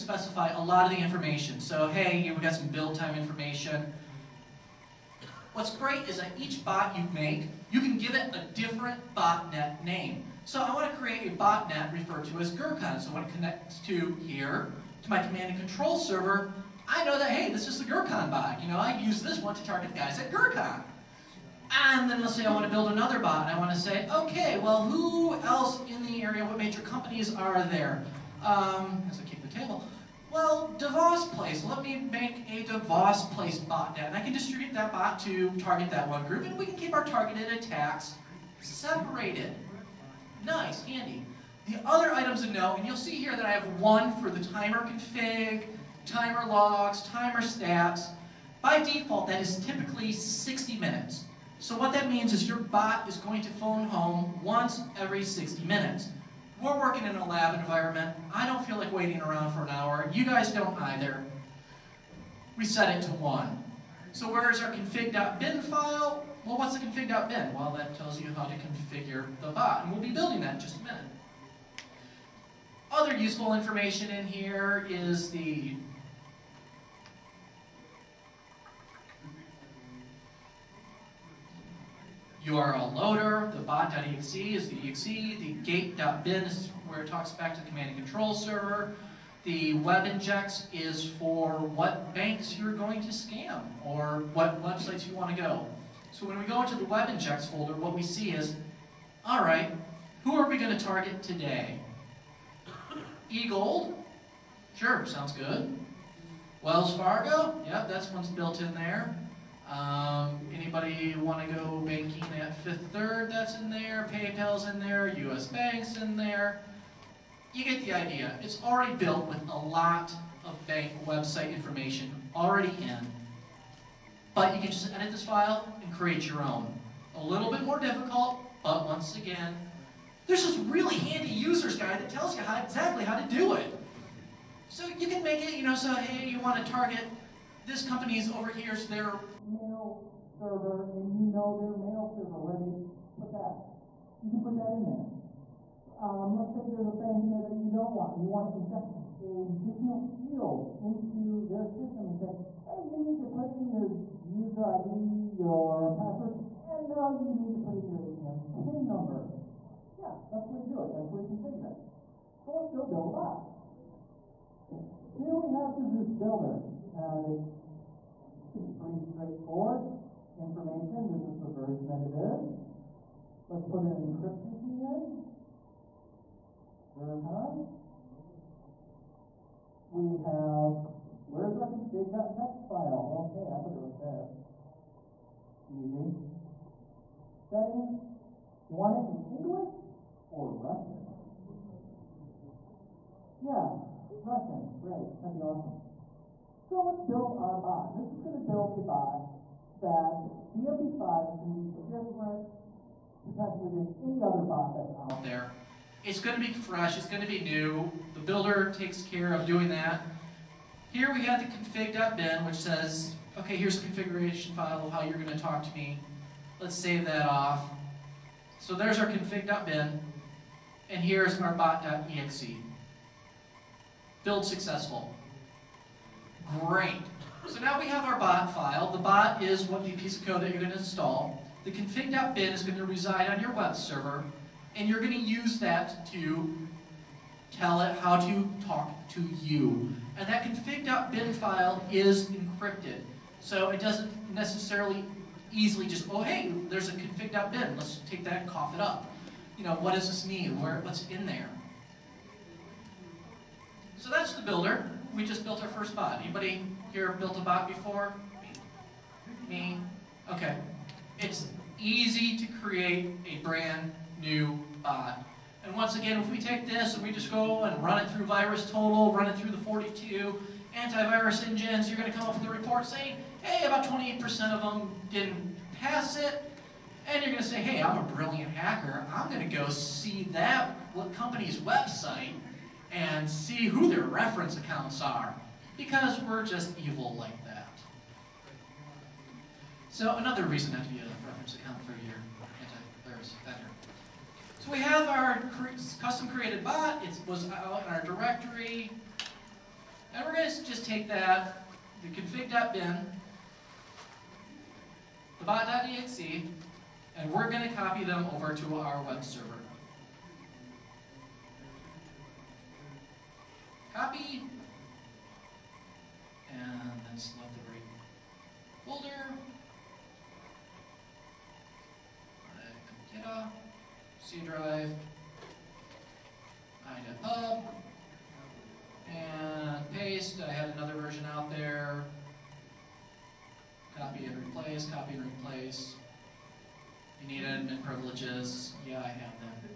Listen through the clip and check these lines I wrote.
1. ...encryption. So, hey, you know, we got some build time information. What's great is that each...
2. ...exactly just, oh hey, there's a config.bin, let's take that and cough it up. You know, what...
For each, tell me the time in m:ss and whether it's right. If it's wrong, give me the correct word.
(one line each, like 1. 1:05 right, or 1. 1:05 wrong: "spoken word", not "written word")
1. 0:01 wrong: "information", not "encryption"
2. 4:05 wrong: "easily", not "exactly".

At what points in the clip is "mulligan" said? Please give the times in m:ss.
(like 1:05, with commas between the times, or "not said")
not said.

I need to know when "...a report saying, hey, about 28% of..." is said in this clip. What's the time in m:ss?
4:32.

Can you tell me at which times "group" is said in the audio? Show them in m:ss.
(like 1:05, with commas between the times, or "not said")
0:36.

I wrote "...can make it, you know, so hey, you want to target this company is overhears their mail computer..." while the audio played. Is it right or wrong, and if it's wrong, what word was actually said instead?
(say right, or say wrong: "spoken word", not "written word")
wrong: "server", not "computer".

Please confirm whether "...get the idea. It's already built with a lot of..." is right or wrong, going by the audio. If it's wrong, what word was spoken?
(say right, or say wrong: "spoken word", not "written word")
right.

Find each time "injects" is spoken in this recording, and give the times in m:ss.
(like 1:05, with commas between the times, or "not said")
1:30, 1:37, 2:28.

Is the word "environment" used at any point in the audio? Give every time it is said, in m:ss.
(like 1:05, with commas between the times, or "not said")
0:57.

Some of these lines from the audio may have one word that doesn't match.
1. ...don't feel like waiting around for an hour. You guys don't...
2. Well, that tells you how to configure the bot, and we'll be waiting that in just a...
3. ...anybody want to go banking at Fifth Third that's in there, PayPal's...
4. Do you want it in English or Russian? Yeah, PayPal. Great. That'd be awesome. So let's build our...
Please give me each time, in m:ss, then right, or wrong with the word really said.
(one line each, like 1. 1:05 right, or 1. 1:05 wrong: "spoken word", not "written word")
1. 0:58 right
2. 1:07 wrong: "building", not "waiting"
3. 1:50 right
4. 3:08 wrong: "Russian", not "PayPal".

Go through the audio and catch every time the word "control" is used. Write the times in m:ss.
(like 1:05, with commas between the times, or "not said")
0:15, 1:27.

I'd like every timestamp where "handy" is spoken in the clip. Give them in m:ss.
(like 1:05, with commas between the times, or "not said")
0:40, 2:10.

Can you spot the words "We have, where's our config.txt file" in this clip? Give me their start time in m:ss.
2:59.